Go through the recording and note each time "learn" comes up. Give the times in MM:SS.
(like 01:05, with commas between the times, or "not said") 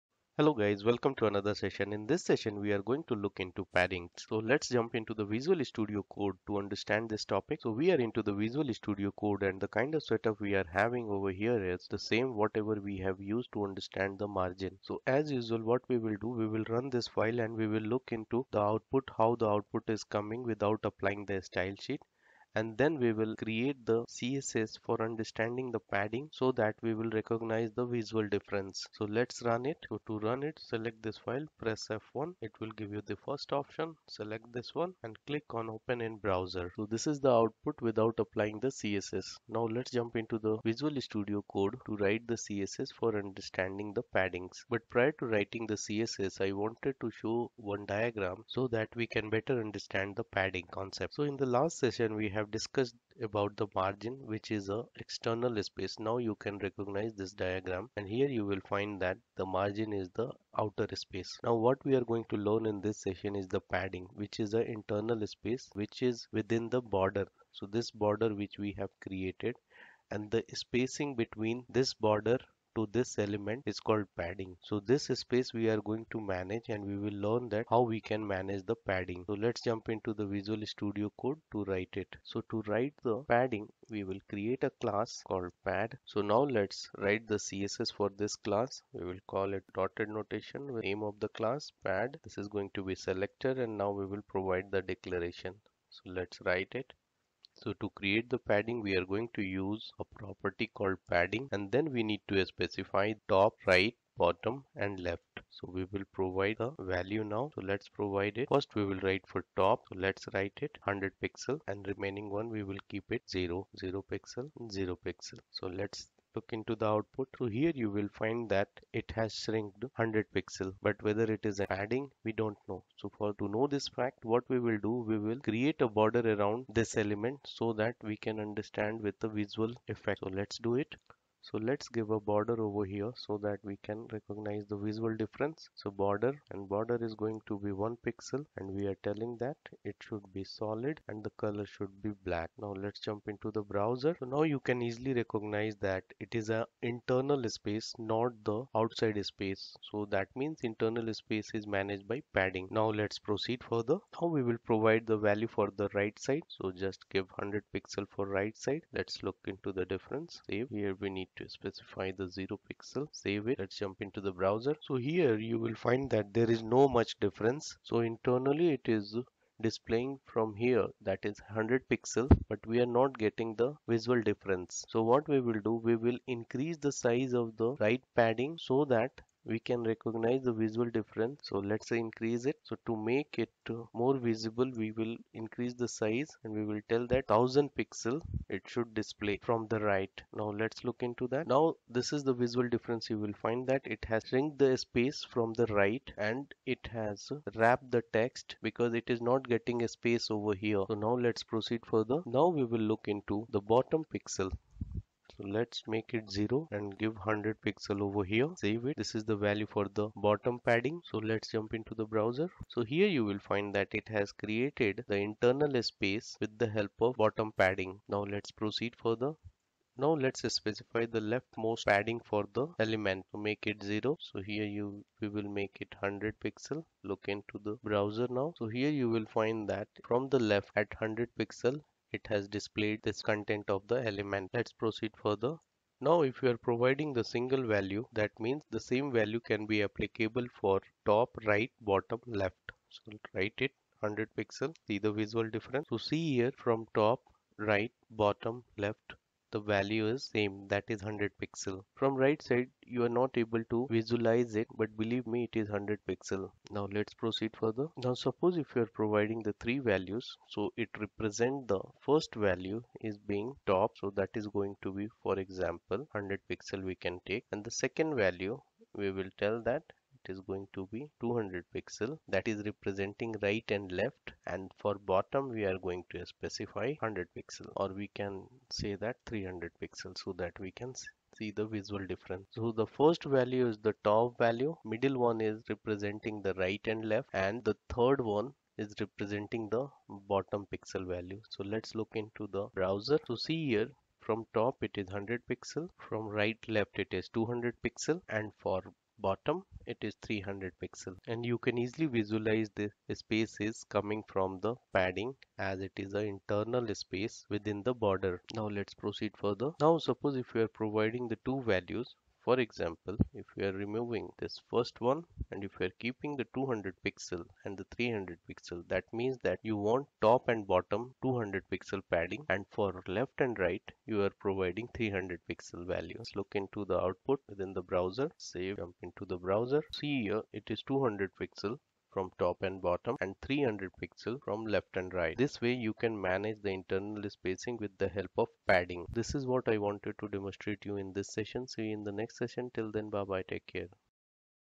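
01:02, 01:17.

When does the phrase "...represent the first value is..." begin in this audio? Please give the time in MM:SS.
04:21.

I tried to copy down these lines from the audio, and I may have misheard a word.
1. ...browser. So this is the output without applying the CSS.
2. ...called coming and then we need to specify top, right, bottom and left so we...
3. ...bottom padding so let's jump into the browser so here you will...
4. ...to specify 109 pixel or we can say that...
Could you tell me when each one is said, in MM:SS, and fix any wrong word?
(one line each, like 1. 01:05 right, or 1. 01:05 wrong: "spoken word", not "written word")
1. 00:36 right
2. 01:40 wrong: "padding", not "coming"
3. 03:30 right
4. 04:36 wrong: "100", not "109".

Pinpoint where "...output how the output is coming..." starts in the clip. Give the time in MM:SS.
00:18.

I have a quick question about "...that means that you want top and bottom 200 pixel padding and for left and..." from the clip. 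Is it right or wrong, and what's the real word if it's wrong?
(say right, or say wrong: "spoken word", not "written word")
right.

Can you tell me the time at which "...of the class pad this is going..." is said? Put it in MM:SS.
01:31.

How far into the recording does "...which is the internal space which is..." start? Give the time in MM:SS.
01:04.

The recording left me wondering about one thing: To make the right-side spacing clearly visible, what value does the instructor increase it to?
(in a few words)
1000 pixels.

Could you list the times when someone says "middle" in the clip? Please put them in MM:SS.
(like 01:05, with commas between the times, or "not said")
04:44.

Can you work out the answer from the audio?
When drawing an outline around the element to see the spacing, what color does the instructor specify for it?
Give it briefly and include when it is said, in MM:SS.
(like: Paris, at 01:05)
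black, at 02:21.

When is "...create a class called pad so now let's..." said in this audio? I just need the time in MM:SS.
01:24.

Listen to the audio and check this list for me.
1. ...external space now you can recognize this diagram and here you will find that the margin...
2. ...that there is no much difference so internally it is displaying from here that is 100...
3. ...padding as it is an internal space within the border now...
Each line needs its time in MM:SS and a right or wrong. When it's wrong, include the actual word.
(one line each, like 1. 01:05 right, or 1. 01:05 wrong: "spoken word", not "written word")
1. 00:55 right
2. 02:46 right
3. 05:04 right.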